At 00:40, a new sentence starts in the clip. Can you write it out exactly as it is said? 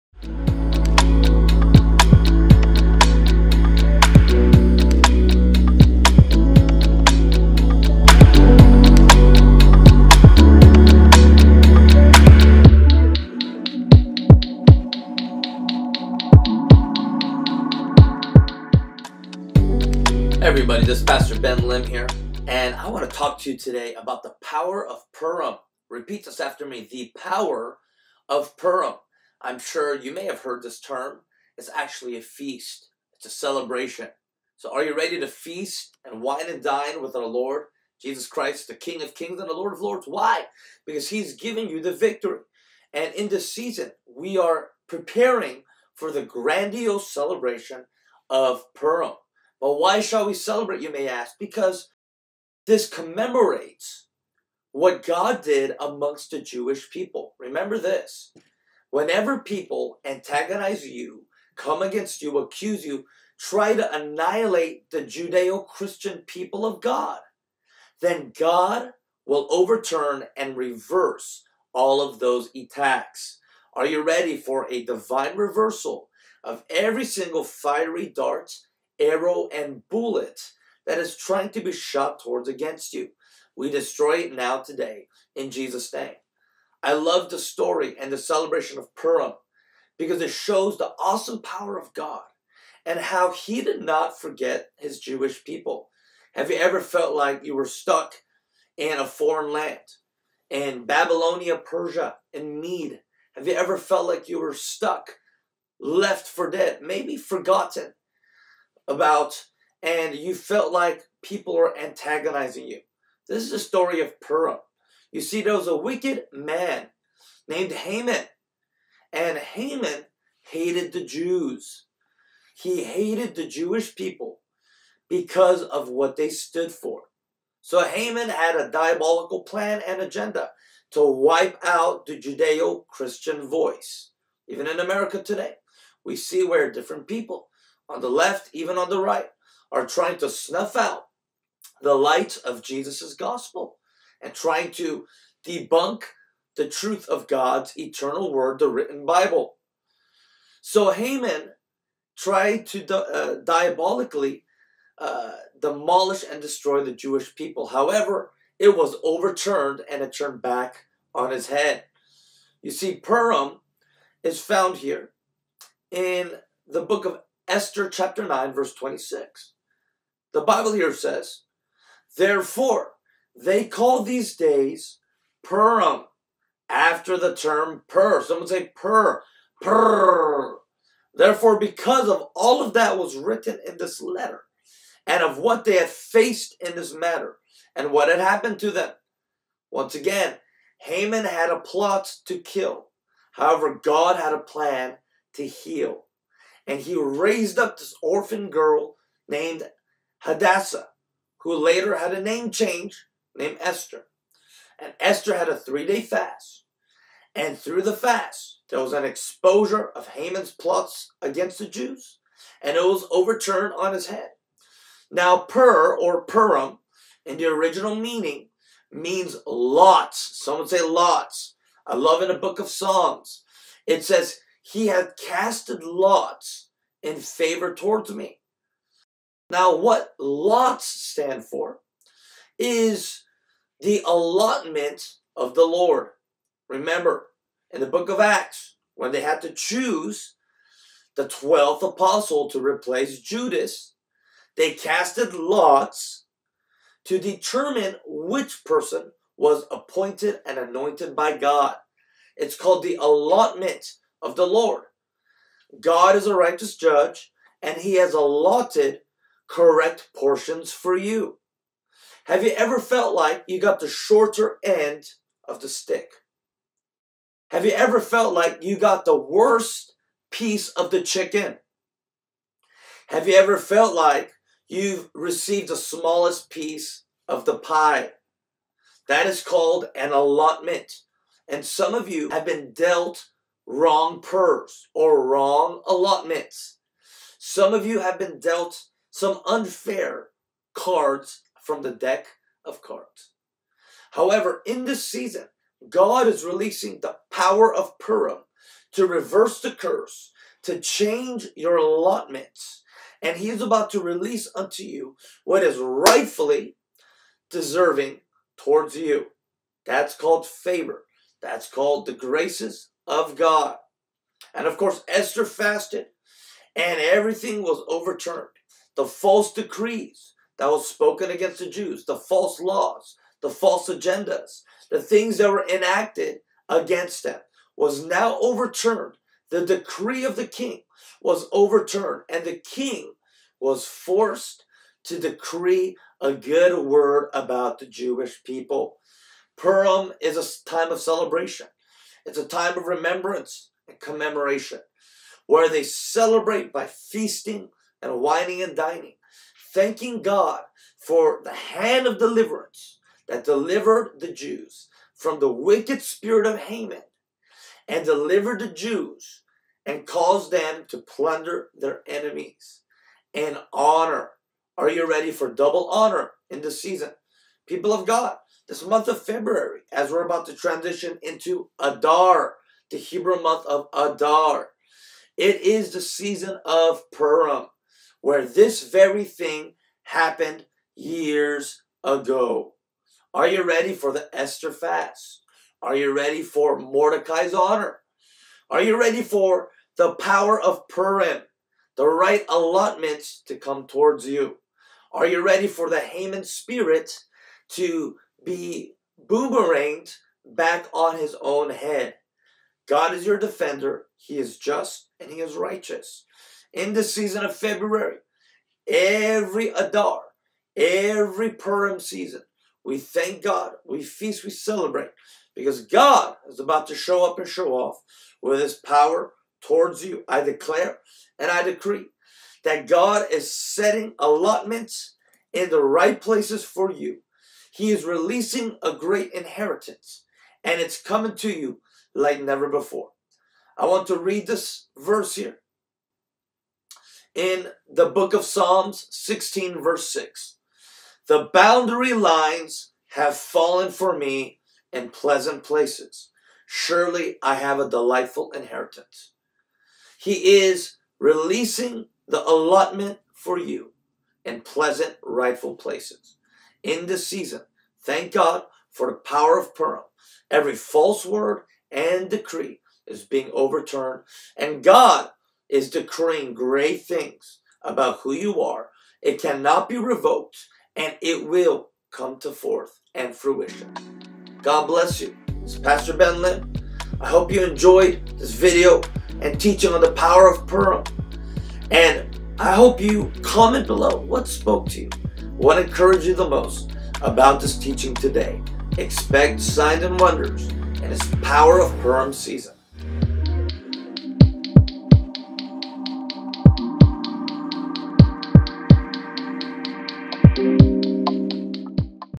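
Because He's giving you the victory.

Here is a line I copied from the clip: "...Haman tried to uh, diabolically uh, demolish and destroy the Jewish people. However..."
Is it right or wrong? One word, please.
right.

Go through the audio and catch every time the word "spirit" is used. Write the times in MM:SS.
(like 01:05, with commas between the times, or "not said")
05:56, 06:36.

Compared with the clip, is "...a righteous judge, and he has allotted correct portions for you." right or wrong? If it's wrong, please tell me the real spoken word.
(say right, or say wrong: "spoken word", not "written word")
right.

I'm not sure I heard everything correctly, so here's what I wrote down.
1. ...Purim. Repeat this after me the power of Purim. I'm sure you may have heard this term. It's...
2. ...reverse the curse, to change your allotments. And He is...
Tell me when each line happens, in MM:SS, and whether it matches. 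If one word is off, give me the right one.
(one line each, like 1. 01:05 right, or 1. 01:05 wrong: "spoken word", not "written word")
1. 00:25 right
2. 04:59 right.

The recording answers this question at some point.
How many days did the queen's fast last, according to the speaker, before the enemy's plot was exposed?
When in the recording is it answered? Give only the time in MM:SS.
03:25.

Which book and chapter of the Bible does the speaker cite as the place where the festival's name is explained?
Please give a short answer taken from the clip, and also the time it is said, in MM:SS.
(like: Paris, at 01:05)
Esther chapter 9, at 02:46.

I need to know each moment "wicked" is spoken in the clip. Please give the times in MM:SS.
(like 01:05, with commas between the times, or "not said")
01:55, 05:55.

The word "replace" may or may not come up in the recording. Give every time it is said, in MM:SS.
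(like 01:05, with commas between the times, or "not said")
04:02.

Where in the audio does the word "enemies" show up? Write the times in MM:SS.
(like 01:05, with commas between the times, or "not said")
06:02.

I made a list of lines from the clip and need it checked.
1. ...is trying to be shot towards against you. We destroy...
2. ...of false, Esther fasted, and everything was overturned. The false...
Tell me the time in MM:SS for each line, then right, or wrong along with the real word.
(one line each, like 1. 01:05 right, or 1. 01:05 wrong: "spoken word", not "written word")
1. 01:20 right
2. 05:14 wrong: "course", not "false".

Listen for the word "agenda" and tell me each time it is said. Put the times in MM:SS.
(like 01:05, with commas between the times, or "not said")
02:10, 05:23.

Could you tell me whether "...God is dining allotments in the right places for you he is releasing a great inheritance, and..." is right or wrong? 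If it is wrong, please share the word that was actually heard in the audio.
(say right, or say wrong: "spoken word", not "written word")
wrong: "setting", not "dining".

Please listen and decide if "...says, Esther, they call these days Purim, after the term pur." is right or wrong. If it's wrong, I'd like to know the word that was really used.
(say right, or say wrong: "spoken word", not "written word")
wrong: "Therefore", not "Esther".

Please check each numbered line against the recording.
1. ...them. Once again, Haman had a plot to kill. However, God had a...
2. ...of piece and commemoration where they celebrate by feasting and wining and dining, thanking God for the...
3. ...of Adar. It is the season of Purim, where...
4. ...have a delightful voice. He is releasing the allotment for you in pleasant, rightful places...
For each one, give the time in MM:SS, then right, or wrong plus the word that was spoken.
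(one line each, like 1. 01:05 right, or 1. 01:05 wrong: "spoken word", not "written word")
1. 03:08 right
2. 05:42 wrong: "remembrance", not "piece"
3. 06:13 right
4. 07:27 wrong: "inheritance", not "voice".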